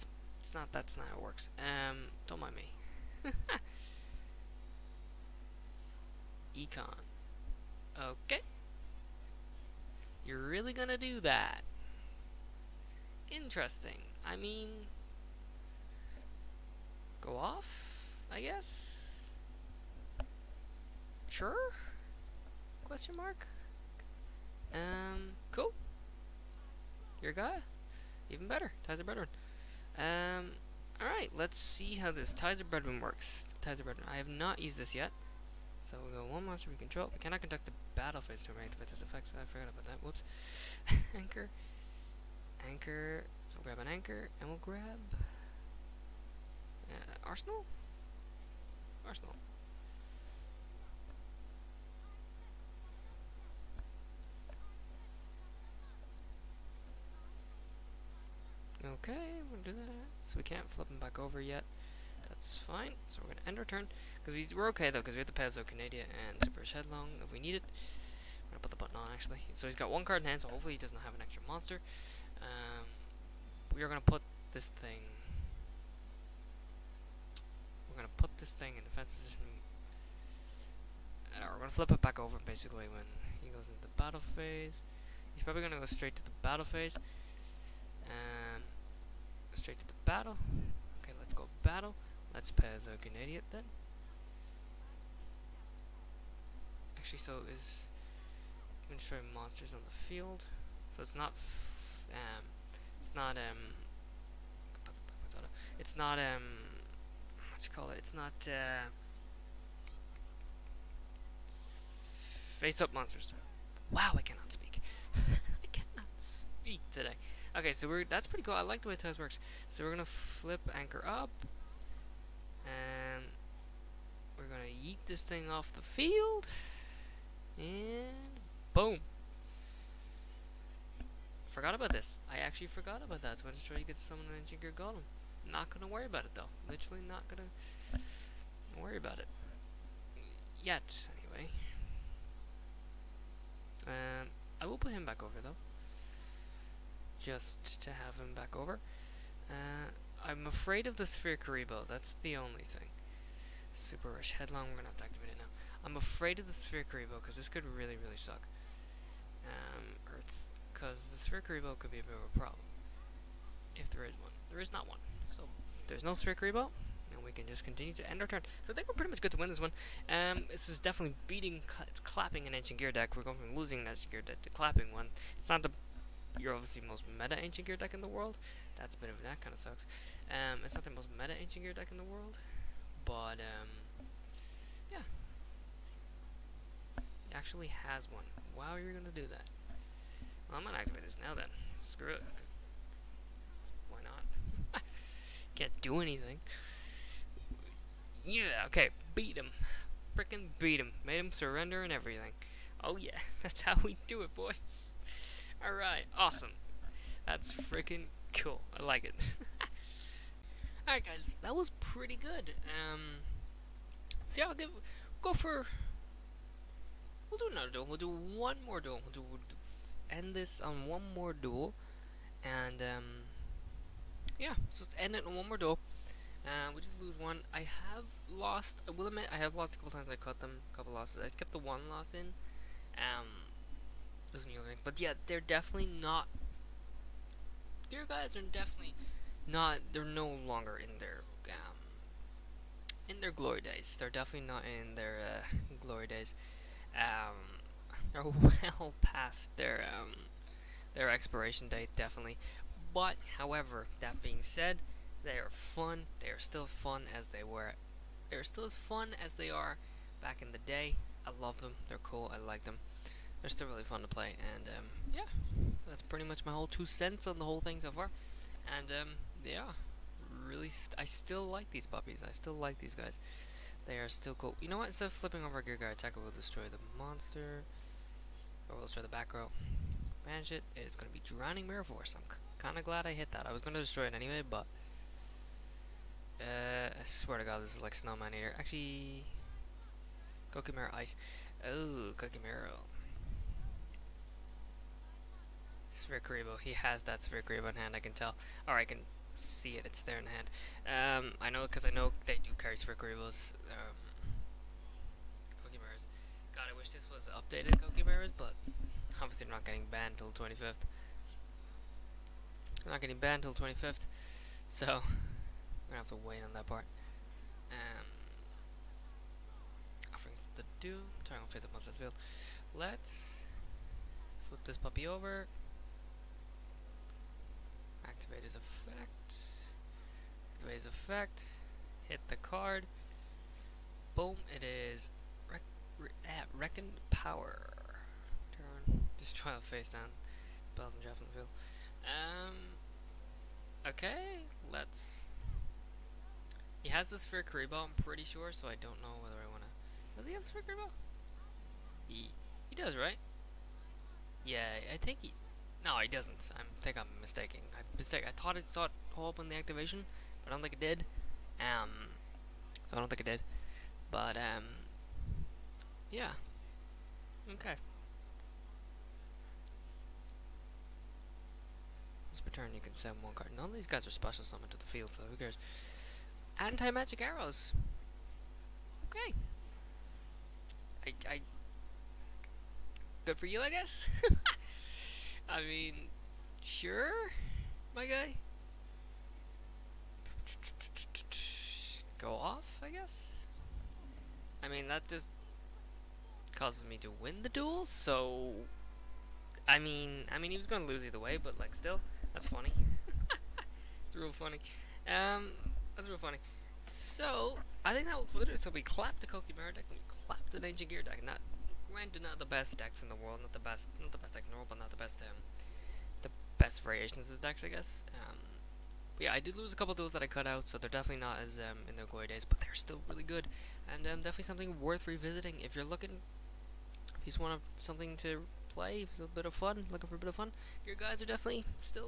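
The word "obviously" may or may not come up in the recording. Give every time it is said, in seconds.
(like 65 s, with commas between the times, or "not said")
176 s, 309 s.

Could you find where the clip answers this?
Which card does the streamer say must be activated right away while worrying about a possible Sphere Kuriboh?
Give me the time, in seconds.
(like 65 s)
153 s.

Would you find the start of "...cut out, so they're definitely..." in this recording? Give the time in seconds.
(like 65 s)
420 s.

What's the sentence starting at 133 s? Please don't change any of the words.
So I just try to get someone an engineer Golem.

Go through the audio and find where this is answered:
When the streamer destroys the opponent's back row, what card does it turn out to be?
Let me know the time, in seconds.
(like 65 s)
281 s.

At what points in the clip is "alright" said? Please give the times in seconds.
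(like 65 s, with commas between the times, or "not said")
31 s, 205 s, 210 s.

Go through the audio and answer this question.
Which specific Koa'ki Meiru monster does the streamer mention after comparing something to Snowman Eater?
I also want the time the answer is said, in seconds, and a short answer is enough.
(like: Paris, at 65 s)
Koa'ki Meiru Ice, at 290 s.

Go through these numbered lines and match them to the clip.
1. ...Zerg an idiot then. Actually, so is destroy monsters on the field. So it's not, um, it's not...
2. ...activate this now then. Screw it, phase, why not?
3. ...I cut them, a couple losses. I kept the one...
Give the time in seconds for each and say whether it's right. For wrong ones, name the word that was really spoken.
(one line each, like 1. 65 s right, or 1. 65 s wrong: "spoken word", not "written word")
1. 92 s right
2. 190 s wrong: "cause", not "phase"
3. 230 s right.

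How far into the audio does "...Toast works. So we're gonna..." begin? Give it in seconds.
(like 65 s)
118 s.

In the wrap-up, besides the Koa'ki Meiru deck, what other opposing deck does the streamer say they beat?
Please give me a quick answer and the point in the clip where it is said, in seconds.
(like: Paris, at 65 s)
Ninja Gear deck, at 410 s.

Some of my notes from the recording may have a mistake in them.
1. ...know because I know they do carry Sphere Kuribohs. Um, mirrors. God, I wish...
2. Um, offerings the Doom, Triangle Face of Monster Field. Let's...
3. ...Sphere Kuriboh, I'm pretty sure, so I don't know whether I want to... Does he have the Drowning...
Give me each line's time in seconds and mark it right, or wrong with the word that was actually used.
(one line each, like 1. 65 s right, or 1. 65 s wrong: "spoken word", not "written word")
1. 301 s right
2. 317 s right
3. 347 s wrong: "Sphere", not "Drowning".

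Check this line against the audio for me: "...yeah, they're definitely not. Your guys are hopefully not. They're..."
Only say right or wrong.
wrong.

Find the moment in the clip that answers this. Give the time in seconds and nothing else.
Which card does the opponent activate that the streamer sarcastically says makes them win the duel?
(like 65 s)
376 s.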